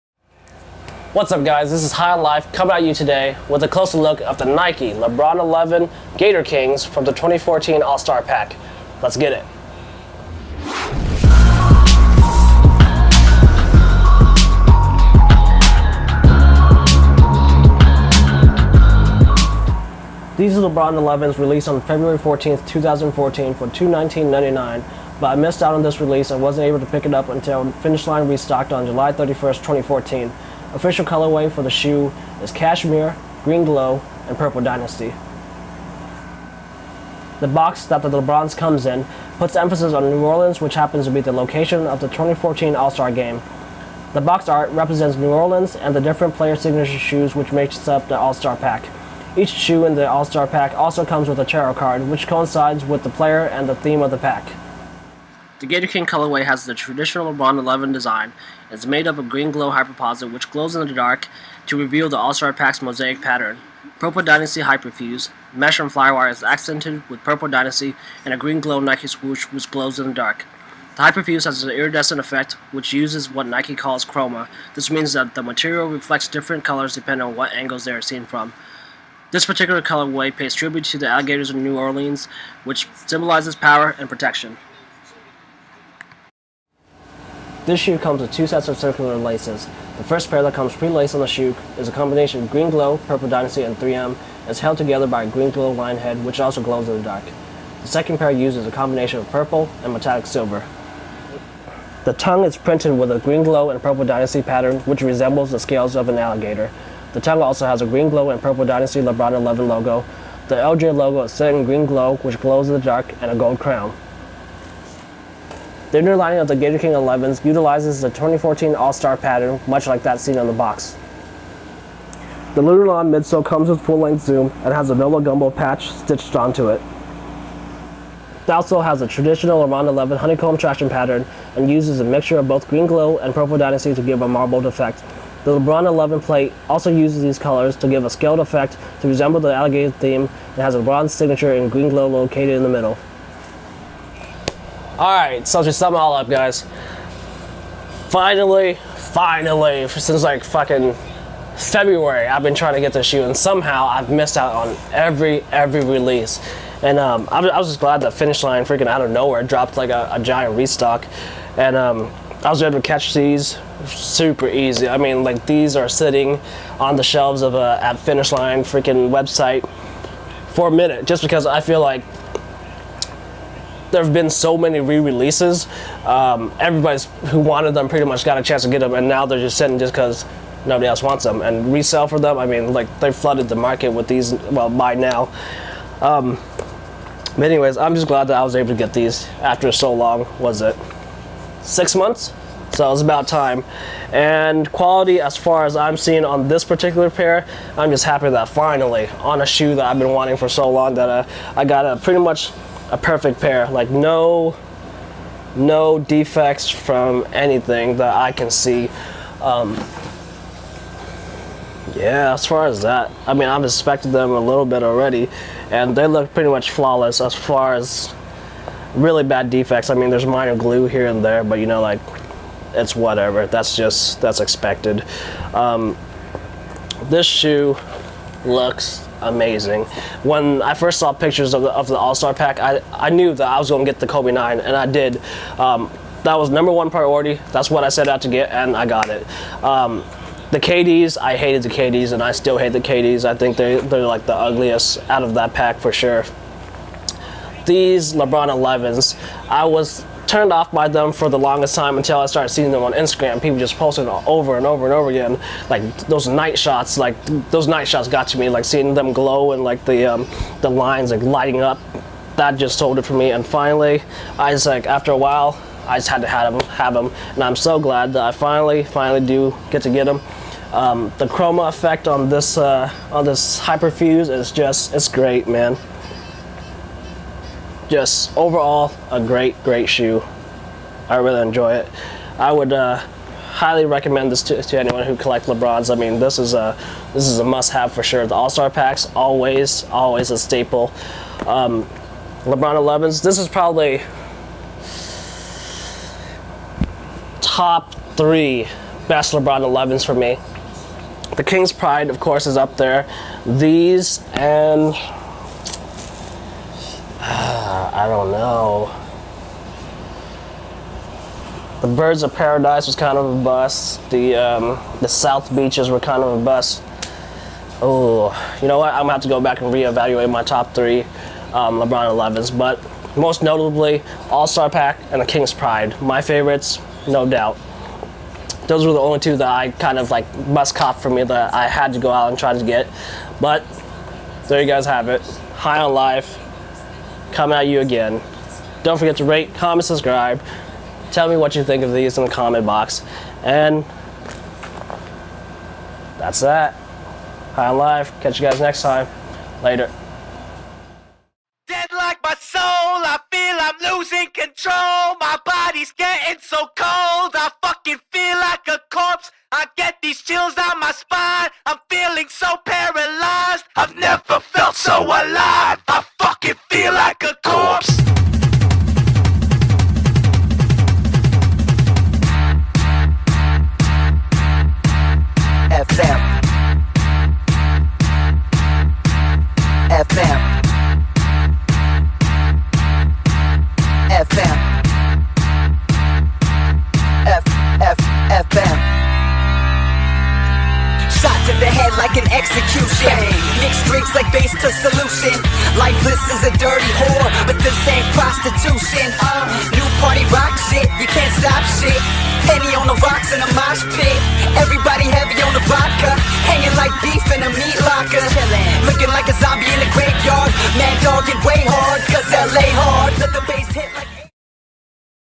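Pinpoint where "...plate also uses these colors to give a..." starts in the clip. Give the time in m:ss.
2:16.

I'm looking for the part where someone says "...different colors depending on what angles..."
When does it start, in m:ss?
1:16.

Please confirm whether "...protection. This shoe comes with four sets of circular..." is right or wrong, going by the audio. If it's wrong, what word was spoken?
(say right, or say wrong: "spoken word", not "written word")
wrong: "two", not "four".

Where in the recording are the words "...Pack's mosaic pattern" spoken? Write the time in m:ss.
1:02.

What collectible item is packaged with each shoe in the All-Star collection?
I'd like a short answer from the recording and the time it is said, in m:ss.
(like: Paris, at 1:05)
A tarot card, at 0:51.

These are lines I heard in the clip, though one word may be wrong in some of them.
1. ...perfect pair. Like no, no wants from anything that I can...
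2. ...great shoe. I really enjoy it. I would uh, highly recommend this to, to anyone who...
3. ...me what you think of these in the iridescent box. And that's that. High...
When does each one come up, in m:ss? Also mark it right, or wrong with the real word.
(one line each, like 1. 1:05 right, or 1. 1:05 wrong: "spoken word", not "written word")
1. 3:22 wrong: "defects", not "wants"
2. 4:39 right
3. 5:41 wrong: "comment", not "iridescent".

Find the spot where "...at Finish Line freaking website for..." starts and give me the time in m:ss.
2:47.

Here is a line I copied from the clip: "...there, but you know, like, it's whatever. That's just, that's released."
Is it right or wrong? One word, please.
wrong.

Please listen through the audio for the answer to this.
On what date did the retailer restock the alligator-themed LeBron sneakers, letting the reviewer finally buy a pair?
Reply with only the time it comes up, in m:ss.
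0:28.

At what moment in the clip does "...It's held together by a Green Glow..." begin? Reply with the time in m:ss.
1:34.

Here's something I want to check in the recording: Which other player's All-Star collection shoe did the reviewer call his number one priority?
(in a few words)
Kobe 9.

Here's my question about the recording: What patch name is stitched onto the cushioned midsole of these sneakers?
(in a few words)
NOLA Gumbo.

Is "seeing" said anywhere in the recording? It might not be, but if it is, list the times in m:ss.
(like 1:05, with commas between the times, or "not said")
3:15, 4:12, 4:18.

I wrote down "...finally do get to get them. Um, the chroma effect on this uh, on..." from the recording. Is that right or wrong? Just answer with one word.
right.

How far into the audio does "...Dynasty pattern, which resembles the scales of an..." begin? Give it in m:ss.
1:44.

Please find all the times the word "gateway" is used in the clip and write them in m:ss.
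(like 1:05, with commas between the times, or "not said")
not said.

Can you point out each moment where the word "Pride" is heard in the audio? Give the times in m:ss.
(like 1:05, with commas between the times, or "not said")
5:01, 5:25.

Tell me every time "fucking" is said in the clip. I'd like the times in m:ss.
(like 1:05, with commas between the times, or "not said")
2:30, 5:57.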